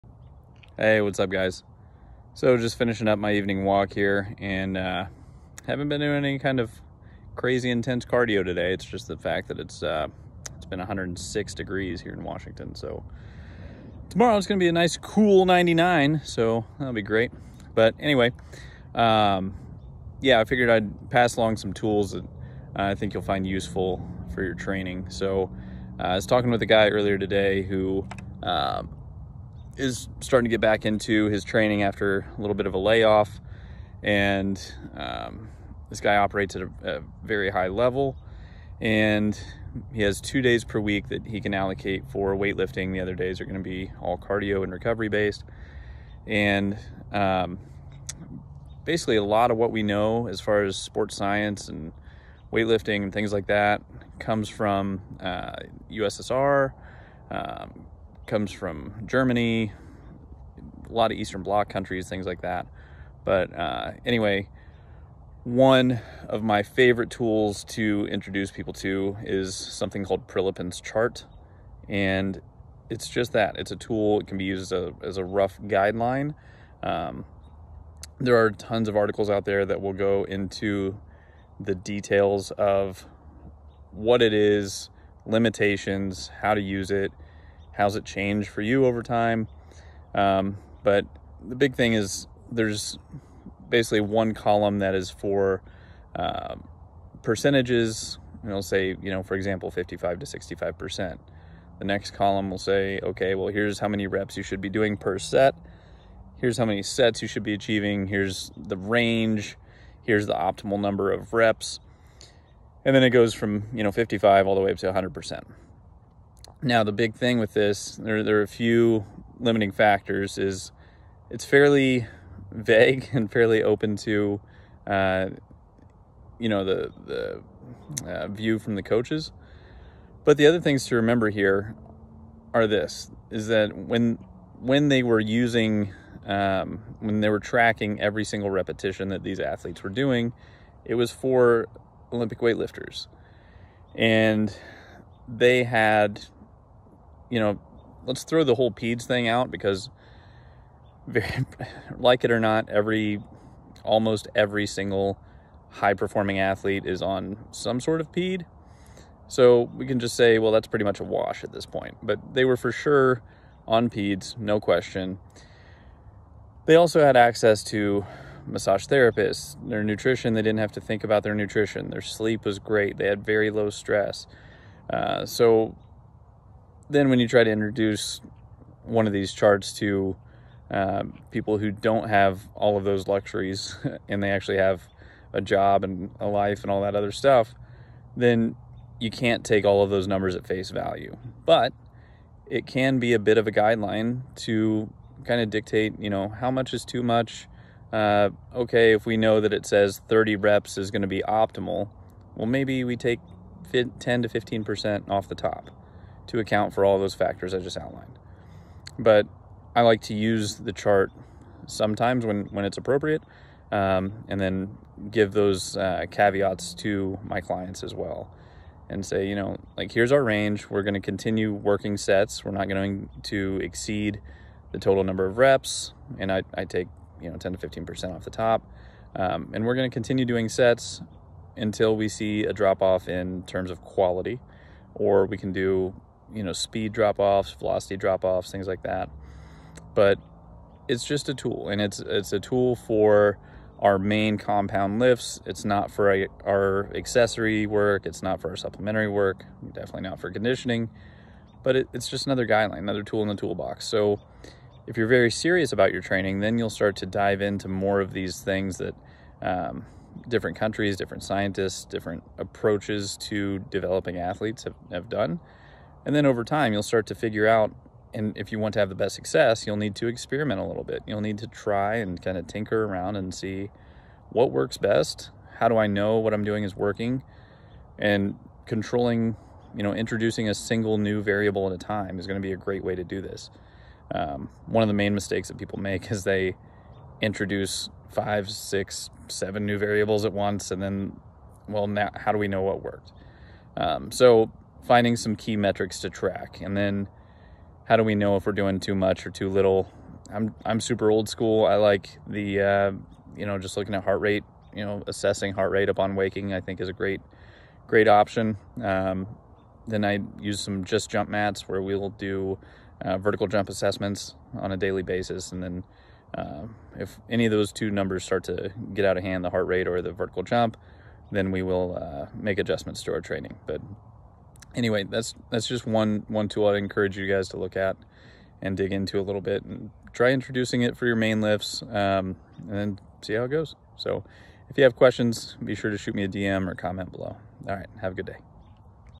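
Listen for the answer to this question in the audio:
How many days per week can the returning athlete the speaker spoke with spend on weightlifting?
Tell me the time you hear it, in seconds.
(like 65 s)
40 s.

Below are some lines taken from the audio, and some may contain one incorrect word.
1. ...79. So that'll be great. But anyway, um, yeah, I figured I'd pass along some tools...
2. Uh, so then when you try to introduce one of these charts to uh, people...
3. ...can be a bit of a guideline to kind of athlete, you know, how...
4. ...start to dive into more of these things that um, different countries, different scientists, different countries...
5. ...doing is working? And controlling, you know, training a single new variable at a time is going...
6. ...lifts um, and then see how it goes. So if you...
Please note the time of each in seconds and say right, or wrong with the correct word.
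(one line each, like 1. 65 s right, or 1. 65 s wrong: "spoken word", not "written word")
1. 15 s wrong: "99", not "79"
2. 174 s right
3. 192 s wrong: "dictate", not "athlete"
4. 256 s wrong: "approaches", not "countries"
5. 276 s wrong: "introducing", not "training"
6. 331 s right.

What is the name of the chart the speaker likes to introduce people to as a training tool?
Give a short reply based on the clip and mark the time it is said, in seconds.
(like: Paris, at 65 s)
Prilipin's chart, at 70 s.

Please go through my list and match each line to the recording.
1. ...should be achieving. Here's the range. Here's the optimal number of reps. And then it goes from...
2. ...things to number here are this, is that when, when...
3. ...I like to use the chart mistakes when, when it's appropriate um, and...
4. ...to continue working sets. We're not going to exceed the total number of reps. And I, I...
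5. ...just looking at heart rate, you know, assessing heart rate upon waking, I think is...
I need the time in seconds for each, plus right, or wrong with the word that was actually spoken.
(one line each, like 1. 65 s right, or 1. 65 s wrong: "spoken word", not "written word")
1. 107 s right
2. 130 s wrong: "remember", not "number"
3. 209 s wrong: "sometimes", not "mistakes"
4. 220 s right
5. 303 s right.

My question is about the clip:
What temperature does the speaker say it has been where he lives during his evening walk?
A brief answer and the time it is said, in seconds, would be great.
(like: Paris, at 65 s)
106 degrees, at 10 s.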